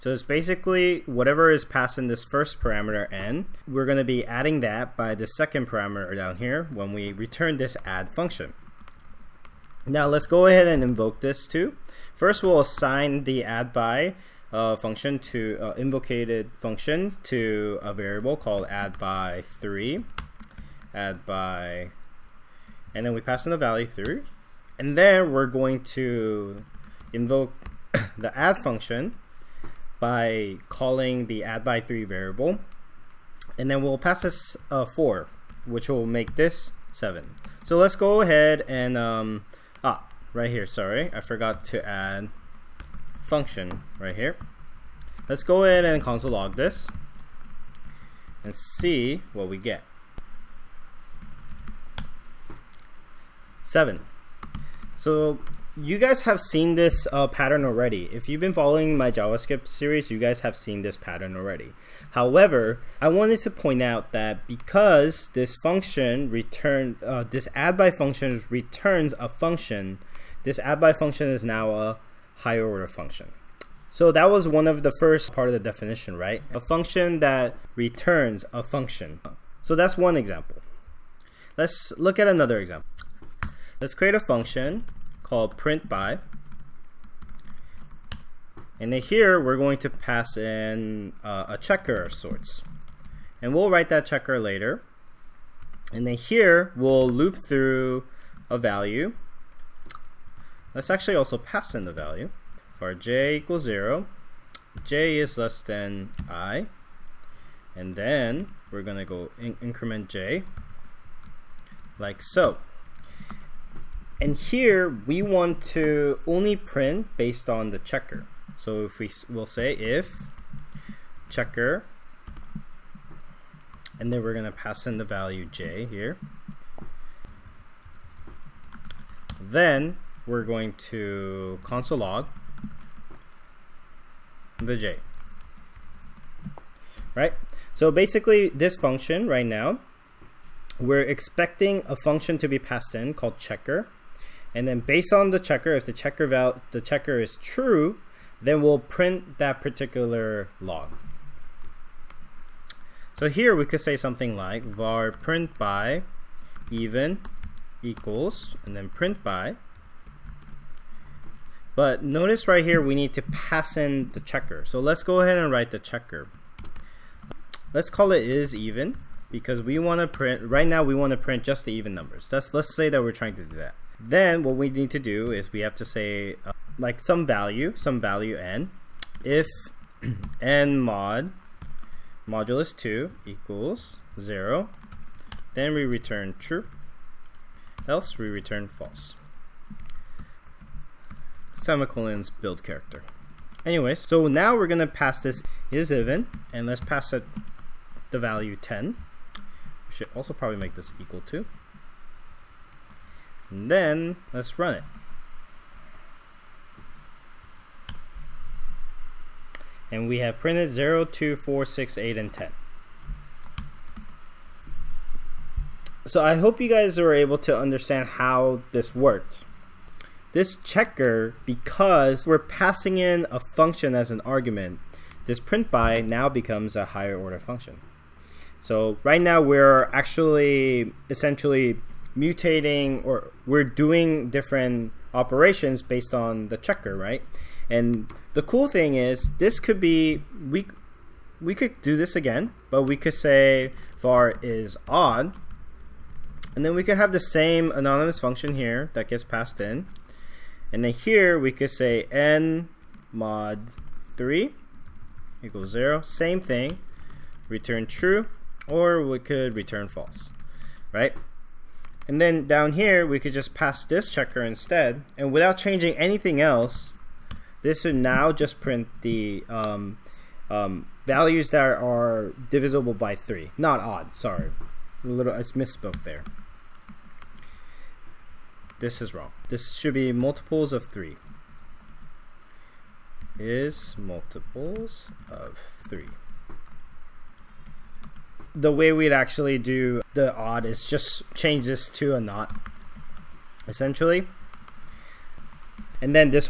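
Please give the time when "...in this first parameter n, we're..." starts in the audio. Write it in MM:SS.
00:01.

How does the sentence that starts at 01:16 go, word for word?
A function that returns a function.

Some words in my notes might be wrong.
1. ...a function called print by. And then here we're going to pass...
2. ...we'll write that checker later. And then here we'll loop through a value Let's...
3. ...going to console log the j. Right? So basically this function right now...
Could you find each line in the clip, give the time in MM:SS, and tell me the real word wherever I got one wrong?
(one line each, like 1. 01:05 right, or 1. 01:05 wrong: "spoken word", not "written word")
1. 01:24 right
2. 01:33 right
3. 02:10 right.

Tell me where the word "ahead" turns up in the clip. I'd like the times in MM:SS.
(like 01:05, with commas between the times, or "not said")
00:10, 00:38, 02:45.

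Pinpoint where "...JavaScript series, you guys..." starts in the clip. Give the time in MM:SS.
00:59.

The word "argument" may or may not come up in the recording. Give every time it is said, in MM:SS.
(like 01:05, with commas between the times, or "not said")
03:44.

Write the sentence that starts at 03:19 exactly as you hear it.
We should also probably make this equal to.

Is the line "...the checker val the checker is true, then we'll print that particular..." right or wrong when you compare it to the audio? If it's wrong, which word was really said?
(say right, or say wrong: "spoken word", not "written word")
right.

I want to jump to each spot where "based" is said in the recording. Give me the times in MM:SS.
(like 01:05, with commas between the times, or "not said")
01:57, 02:24, 03:55.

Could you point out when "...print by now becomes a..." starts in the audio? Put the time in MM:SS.
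03:45.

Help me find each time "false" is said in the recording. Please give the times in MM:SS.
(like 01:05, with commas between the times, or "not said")
03:08, 04:19.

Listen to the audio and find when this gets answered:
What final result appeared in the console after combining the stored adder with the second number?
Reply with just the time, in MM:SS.
00:53.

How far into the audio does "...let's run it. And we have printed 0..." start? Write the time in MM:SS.
03:24.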